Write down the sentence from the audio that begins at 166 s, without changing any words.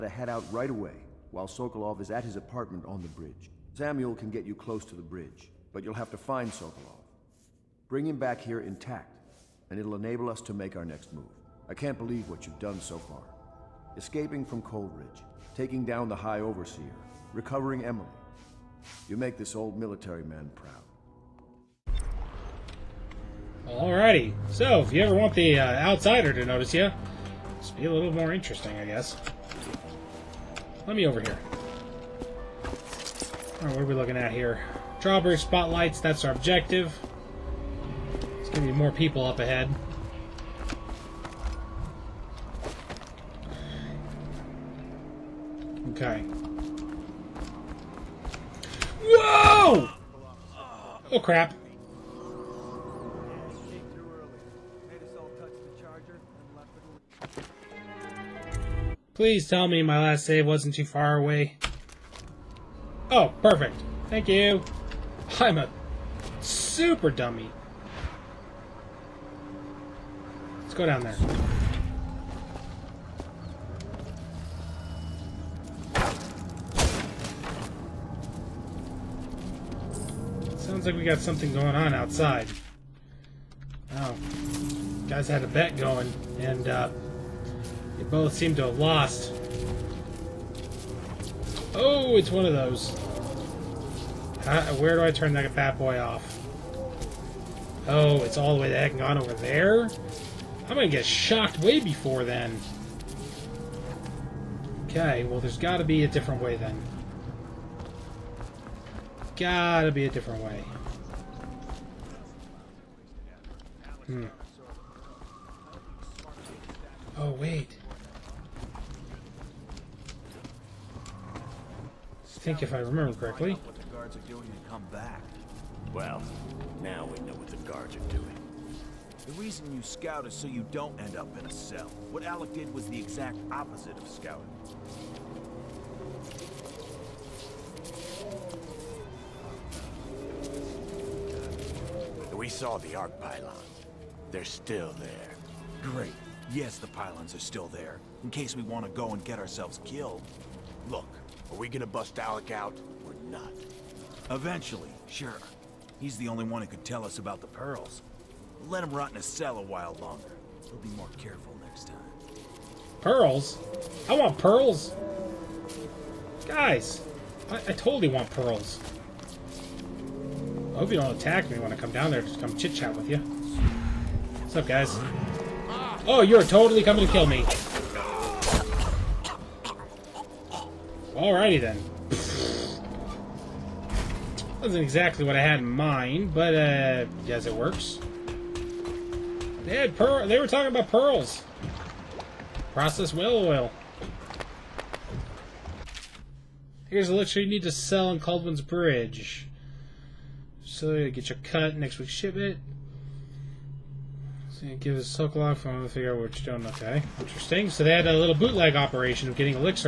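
Guys, I, I totally want pearls.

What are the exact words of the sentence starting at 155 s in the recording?
He's the only one who could tell us about the pearls.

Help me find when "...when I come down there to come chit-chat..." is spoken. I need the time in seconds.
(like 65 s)
171 s.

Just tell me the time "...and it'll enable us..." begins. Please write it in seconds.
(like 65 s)
9 s.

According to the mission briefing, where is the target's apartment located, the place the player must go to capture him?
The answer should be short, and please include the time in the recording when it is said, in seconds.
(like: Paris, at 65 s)
On the bridge, at 2 s.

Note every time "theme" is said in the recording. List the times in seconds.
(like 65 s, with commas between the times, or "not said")
not said.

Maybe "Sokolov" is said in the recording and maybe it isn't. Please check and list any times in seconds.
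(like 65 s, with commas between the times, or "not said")
1 s, 6 s.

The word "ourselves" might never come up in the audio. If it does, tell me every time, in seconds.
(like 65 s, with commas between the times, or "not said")
149 s.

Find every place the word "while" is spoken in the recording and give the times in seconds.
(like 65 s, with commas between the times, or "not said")
1 s, 159 s.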